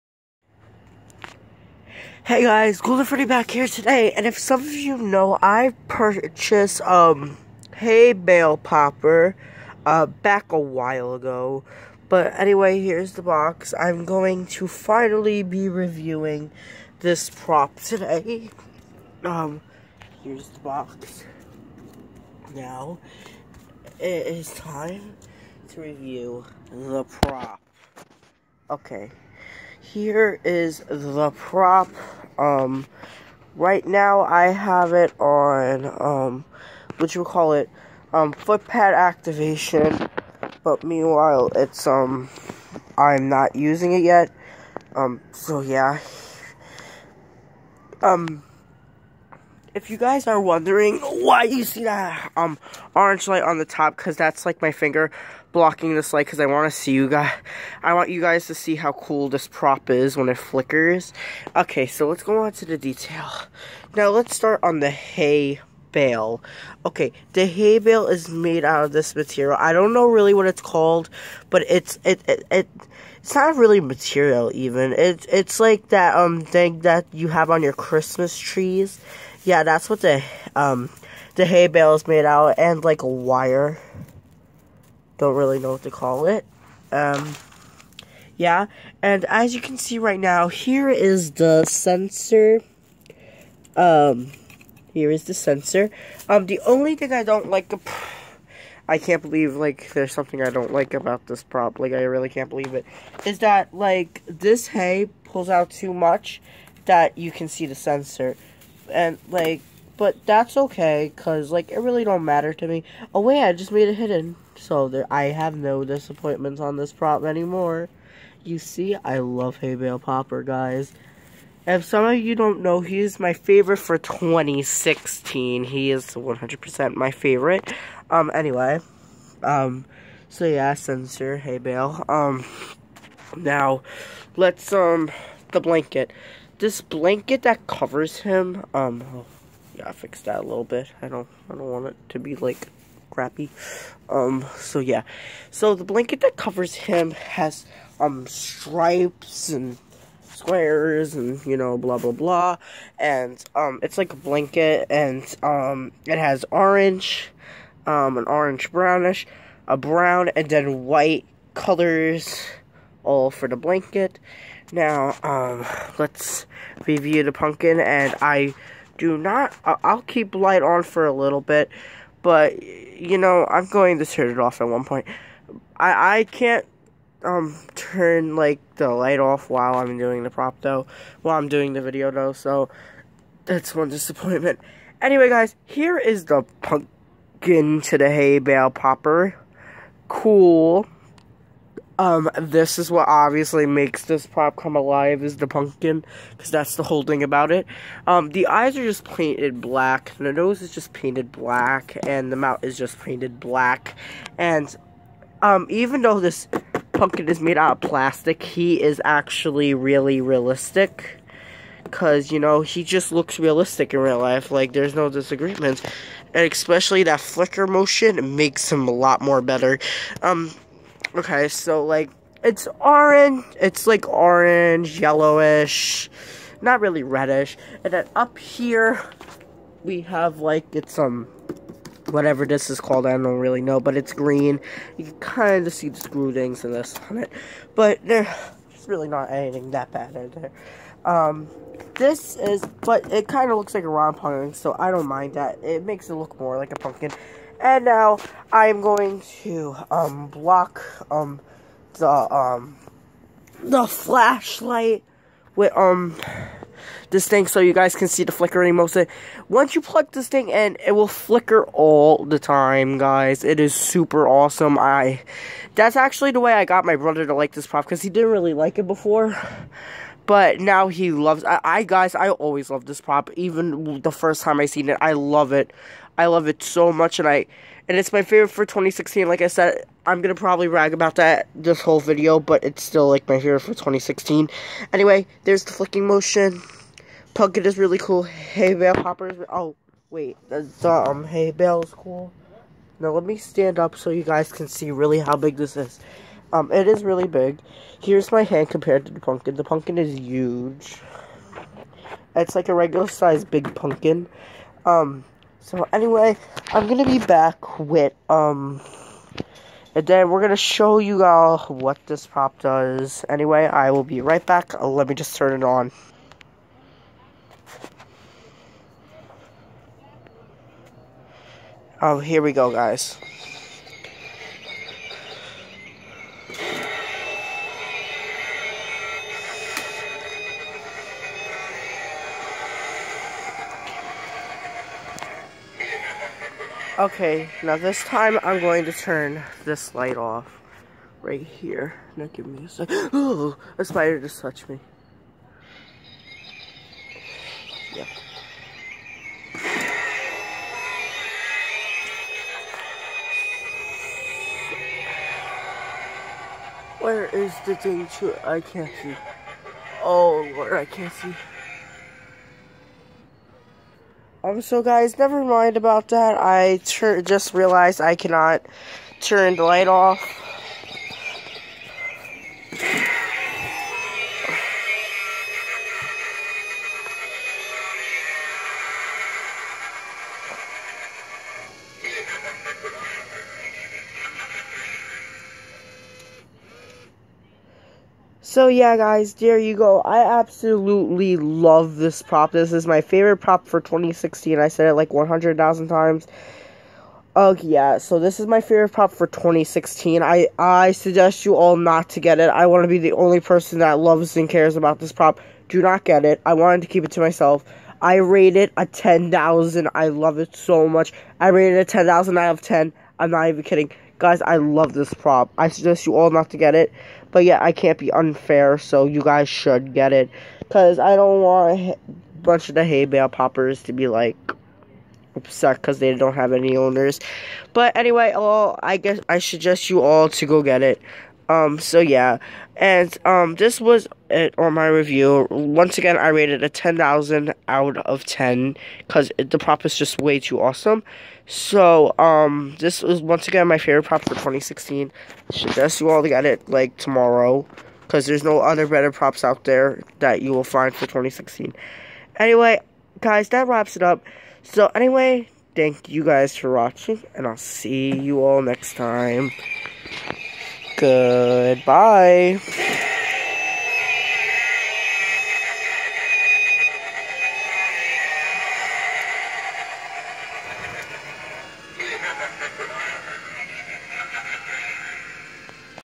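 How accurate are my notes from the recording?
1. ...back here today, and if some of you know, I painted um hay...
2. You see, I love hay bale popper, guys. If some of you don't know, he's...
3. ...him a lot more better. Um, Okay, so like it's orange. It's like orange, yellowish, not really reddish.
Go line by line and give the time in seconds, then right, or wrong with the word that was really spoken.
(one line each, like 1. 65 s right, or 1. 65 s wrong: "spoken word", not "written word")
1. 3 s wrong: "purchased", not "painted"
2. 118 s right
3. 218 s right.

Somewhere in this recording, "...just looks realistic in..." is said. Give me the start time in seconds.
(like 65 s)
212 s.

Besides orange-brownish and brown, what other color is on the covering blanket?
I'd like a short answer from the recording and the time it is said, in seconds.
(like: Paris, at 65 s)
white, at 160 s.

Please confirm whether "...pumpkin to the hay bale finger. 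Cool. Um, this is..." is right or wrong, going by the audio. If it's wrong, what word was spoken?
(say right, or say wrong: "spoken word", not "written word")
wrong: "popper", not "finger".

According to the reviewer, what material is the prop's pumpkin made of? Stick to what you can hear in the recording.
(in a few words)
plastic.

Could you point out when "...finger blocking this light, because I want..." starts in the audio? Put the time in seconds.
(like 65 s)
54 s.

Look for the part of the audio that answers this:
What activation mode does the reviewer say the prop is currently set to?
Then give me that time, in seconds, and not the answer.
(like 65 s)
38 s.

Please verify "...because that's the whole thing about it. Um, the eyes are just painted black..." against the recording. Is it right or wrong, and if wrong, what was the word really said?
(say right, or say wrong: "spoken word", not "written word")
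right.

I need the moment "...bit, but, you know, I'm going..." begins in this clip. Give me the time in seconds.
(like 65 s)
171 s.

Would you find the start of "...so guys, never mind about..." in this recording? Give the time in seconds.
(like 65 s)
364 s.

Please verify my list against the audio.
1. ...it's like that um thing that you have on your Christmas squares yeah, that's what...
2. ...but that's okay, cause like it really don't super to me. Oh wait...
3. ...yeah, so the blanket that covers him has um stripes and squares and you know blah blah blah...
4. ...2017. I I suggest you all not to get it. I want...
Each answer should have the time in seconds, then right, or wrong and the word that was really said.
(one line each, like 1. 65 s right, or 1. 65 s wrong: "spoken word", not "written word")
1. 75 s wrong: "trees", not "squares"
2. 109 s wrong: "matter", not "super"
3. 144 s right
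4. 399 s wrong: "2016", not "2017".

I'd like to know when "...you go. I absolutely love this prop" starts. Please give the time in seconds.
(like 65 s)
389 s.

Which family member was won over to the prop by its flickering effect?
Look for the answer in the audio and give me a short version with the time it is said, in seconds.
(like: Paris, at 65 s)
brother, at 266 s.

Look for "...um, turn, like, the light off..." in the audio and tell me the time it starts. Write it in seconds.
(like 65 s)
177 s.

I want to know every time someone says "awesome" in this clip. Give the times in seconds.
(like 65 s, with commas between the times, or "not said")
264 s, 440 s.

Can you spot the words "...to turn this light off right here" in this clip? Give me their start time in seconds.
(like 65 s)
338 s.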